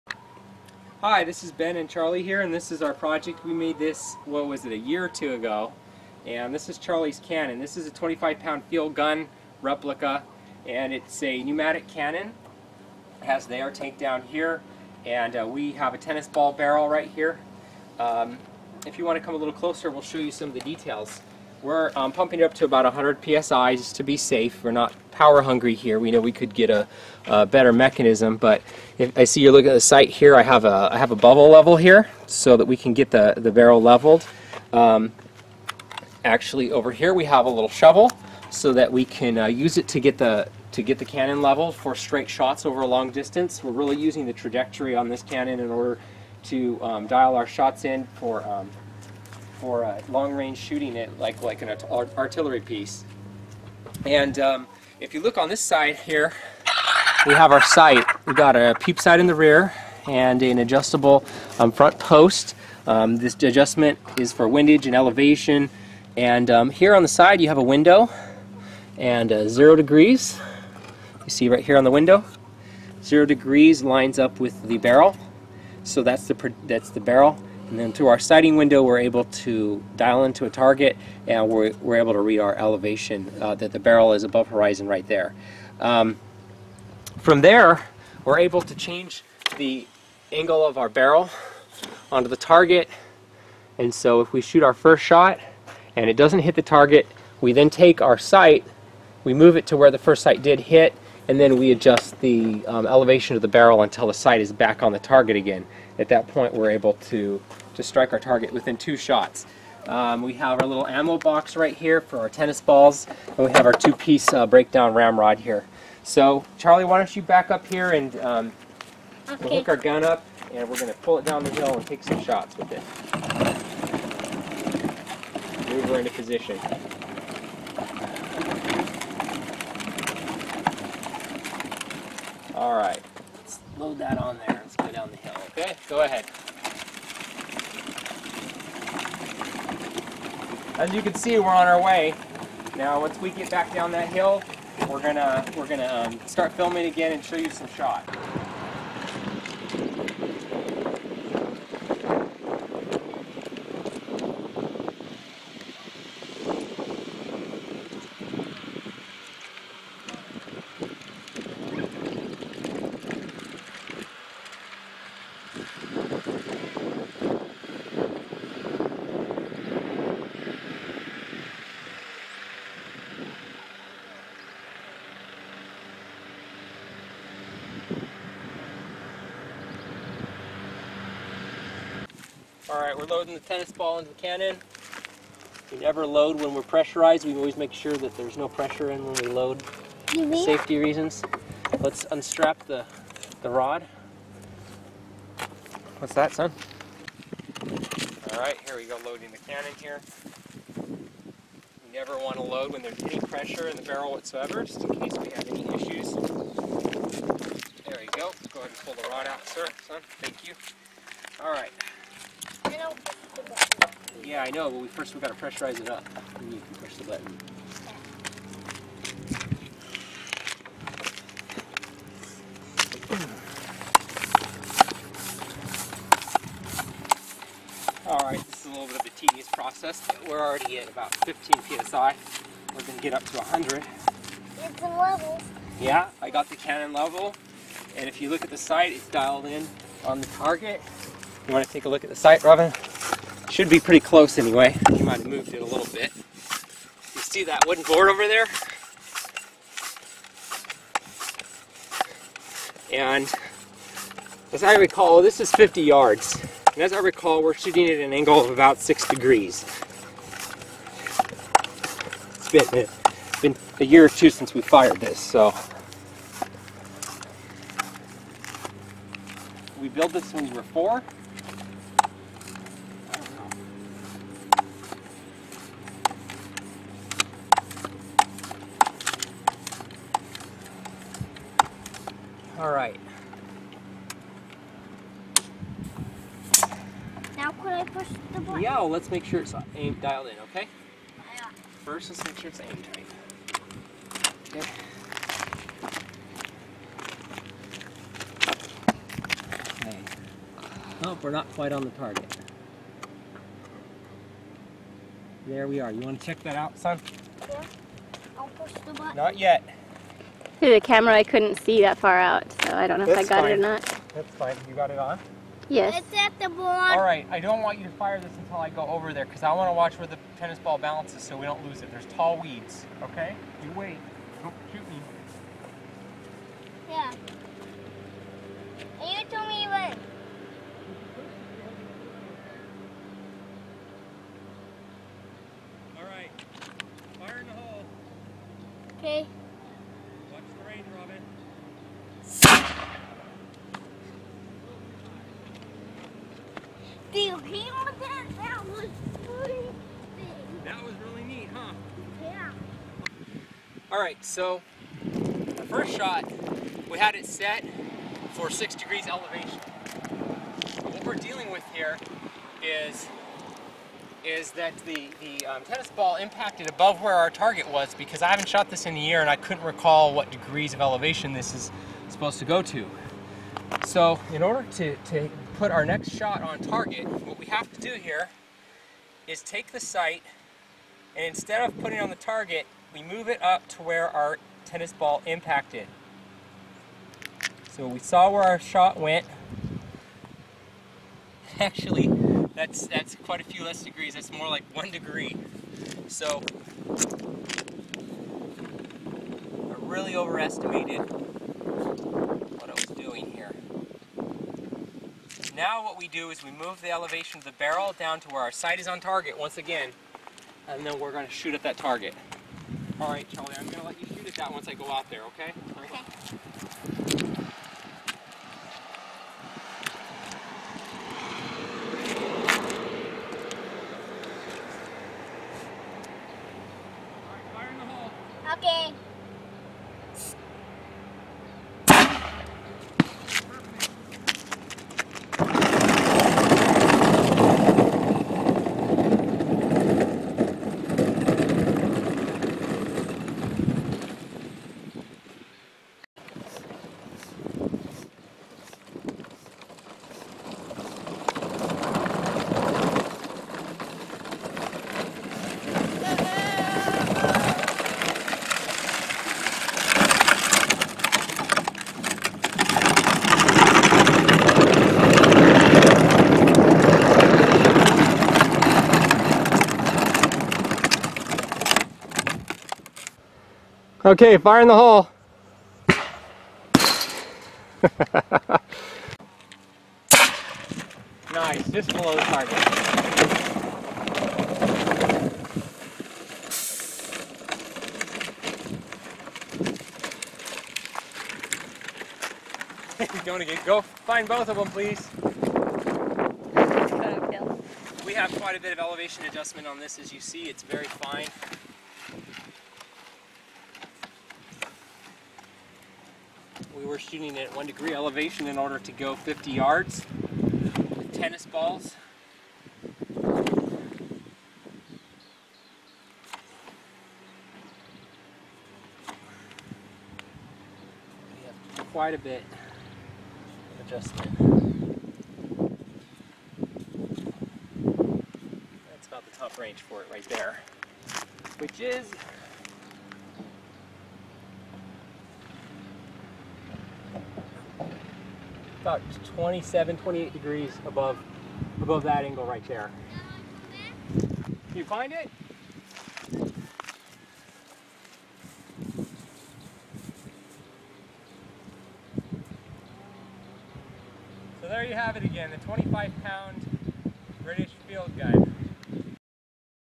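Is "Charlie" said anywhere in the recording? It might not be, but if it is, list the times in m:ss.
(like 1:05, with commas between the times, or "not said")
0:01, 0:06, 1:56, 6:53.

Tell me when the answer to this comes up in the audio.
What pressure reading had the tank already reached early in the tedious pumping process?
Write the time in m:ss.
3:51.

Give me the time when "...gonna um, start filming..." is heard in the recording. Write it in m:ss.
2:25.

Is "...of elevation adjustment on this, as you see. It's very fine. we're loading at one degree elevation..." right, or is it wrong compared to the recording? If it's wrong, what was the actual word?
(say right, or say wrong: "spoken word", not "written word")
wrong: "shooting", not "loading".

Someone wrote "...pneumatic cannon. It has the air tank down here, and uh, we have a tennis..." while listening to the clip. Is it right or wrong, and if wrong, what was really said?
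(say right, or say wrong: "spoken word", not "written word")
right.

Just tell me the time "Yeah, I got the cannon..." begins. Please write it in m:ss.
3:55.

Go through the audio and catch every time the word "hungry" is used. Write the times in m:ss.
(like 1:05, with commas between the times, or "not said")
0:25.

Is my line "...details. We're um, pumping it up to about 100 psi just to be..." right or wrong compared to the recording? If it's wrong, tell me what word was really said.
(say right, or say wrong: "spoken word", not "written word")
right.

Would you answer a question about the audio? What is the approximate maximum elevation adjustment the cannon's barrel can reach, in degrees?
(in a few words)
27-28 degrees.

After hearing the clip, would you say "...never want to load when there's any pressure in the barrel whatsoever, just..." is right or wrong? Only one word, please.
right.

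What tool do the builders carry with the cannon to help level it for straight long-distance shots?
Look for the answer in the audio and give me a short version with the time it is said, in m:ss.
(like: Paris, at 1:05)
shovel, at 0:37.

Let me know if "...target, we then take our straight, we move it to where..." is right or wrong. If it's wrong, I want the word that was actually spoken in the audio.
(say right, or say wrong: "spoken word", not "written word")
wrong: "sight", not "straight".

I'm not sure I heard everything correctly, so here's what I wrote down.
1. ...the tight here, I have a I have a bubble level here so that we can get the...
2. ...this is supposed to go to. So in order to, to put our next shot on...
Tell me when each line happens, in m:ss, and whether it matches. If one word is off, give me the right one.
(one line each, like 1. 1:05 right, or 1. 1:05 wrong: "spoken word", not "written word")
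1. 0:29 wrong: "sight", not "tight"
2. 6:11 right.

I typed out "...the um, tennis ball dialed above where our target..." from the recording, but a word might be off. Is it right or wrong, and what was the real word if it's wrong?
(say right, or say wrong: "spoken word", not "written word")
wrong: "impacted", not "dialed".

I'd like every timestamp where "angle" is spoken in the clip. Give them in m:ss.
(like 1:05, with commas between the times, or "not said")
1:30, 4:18, 9:02.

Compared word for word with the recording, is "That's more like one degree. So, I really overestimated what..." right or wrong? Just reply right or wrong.
right.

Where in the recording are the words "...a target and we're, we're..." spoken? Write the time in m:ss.
1:20.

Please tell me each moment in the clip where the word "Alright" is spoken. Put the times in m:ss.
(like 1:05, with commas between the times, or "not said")
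3:02, 3:18, 3:31, 3:48.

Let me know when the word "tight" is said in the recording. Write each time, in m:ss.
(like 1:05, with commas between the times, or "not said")
4:52.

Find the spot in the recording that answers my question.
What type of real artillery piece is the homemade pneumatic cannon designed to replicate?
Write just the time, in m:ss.
0:07.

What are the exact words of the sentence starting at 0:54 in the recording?
And um, if you look on this side here, we have our sight.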